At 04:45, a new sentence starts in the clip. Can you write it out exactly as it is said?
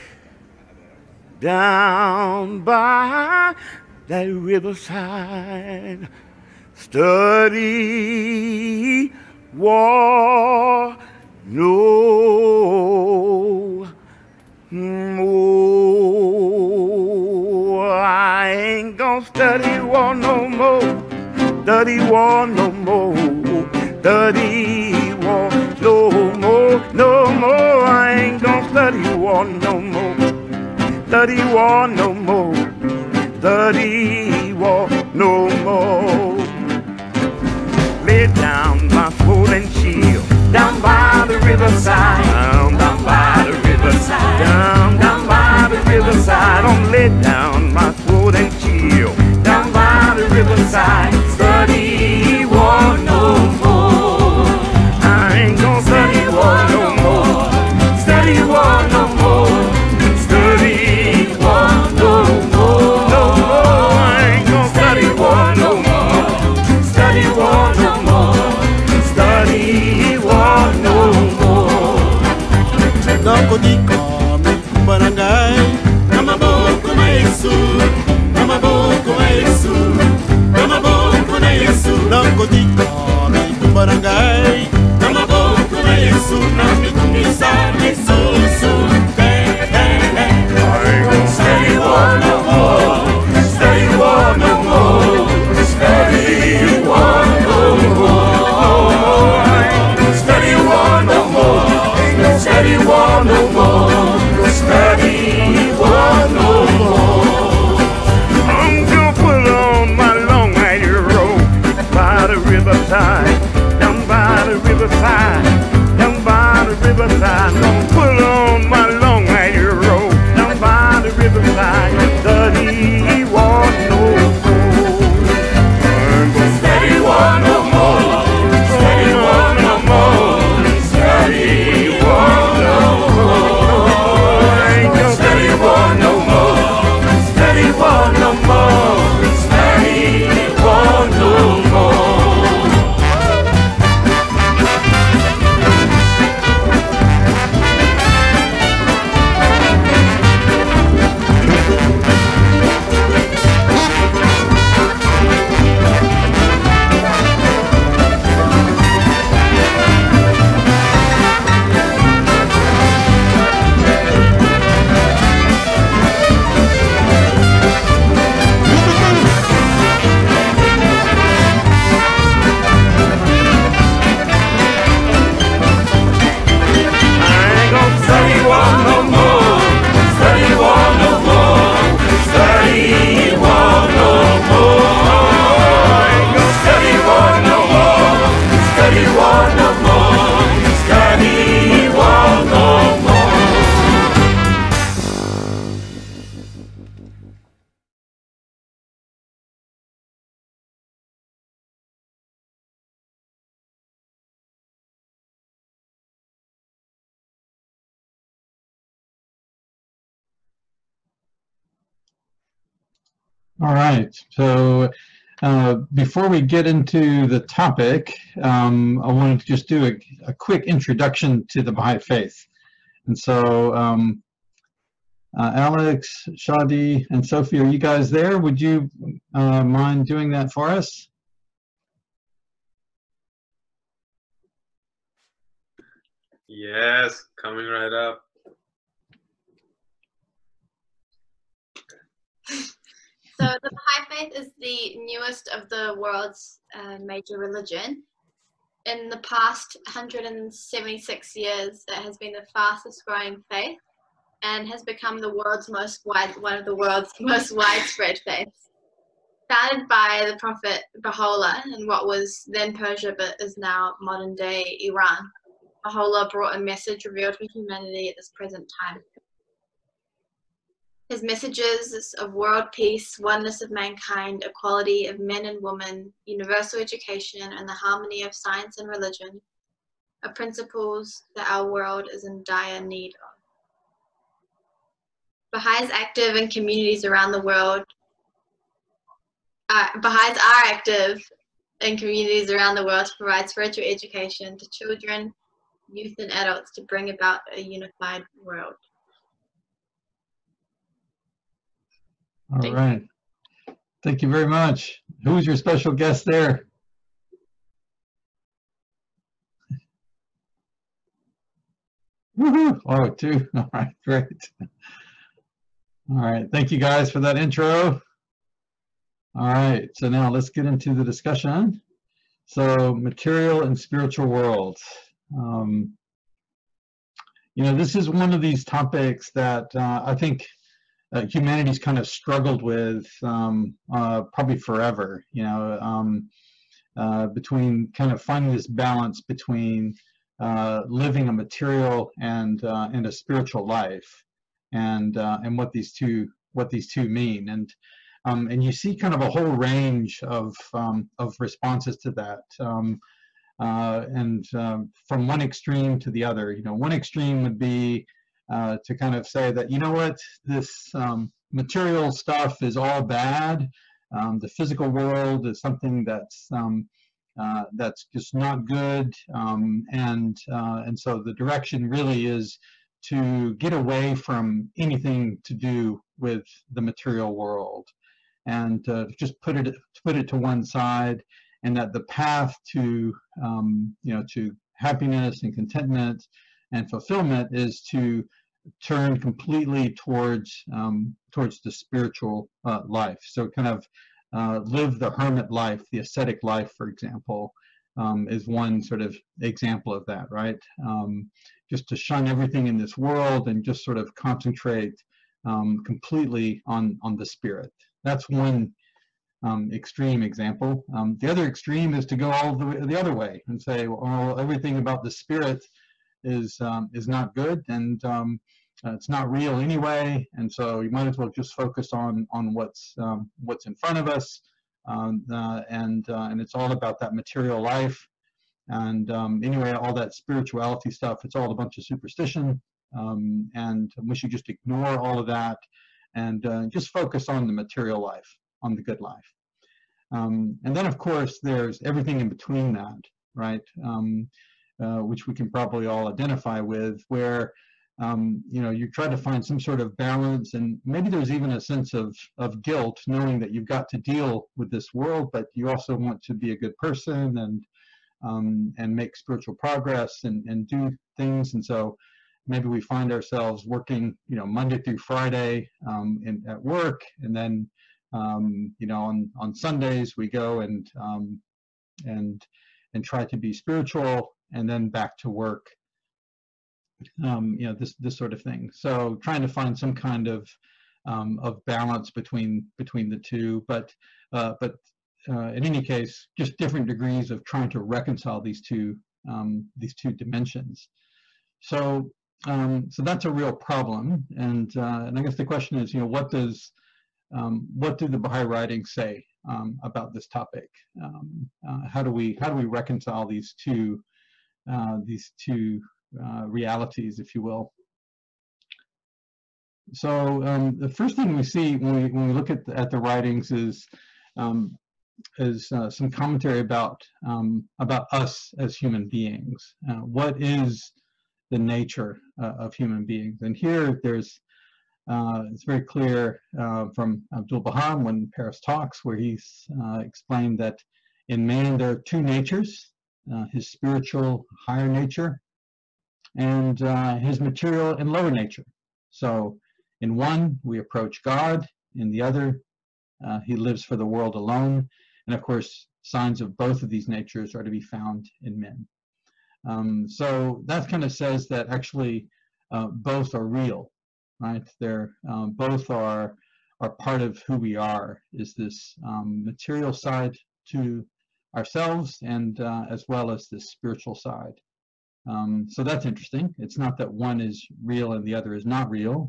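Baha'is active in communities around the world.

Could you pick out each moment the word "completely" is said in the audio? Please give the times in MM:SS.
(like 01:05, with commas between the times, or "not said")
06:29, 06:45.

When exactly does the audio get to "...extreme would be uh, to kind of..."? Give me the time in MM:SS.
05:56.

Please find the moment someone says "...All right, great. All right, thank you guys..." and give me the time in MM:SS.
05:13.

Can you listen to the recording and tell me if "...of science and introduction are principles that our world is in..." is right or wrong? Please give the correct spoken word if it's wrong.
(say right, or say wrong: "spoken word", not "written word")
wrong: "religion", not "introduction".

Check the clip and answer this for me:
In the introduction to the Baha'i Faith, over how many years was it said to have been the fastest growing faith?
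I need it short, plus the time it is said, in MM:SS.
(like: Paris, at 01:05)
176, at 04:09.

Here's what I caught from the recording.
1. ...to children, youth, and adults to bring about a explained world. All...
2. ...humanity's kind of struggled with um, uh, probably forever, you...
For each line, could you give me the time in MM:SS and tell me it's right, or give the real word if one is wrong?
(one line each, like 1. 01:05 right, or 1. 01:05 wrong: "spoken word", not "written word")
1. 04:54 wrong: "unified", not "explained"
2. 05:31 right.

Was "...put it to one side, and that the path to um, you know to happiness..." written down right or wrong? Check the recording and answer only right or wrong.
right.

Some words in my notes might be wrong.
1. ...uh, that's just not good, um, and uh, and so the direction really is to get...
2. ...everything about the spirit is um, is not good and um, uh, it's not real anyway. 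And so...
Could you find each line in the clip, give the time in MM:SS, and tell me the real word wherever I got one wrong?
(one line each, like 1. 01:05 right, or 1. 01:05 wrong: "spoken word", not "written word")
1. 06:07 right
2. 06:54 right.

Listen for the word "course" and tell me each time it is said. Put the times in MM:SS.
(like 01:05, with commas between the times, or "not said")
07:20, 09:05.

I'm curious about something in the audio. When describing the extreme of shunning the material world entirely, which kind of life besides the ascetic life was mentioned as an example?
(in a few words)
hermit life.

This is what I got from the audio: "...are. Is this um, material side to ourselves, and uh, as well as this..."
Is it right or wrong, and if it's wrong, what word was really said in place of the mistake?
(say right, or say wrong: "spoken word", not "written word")
right.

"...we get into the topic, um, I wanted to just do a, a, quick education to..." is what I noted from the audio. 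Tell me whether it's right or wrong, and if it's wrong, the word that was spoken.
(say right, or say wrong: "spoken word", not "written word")
wrong: "introduction", not "education".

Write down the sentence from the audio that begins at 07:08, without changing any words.
And um, anyway, all that spirituality stuff, it's all a bunch of superstition.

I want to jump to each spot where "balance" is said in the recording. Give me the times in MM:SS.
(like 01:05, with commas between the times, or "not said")
05:38, 07:29, 08:01.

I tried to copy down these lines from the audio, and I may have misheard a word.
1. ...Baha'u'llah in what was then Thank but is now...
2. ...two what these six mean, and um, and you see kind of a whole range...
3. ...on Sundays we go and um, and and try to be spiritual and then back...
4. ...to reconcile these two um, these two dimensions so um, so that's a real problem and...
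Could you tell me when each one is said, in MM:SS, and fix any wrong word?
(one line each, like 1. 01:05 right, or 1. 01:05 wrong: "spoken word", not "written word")
1. 04:21 wrong: "Persia", not "Thank"
2. 05:45 wrong: "two", not "six"
3. 07:49 right
4. 08:07 right.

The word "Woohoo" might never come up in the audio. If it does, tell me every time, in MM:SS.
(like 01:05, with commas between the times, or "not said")
05:12.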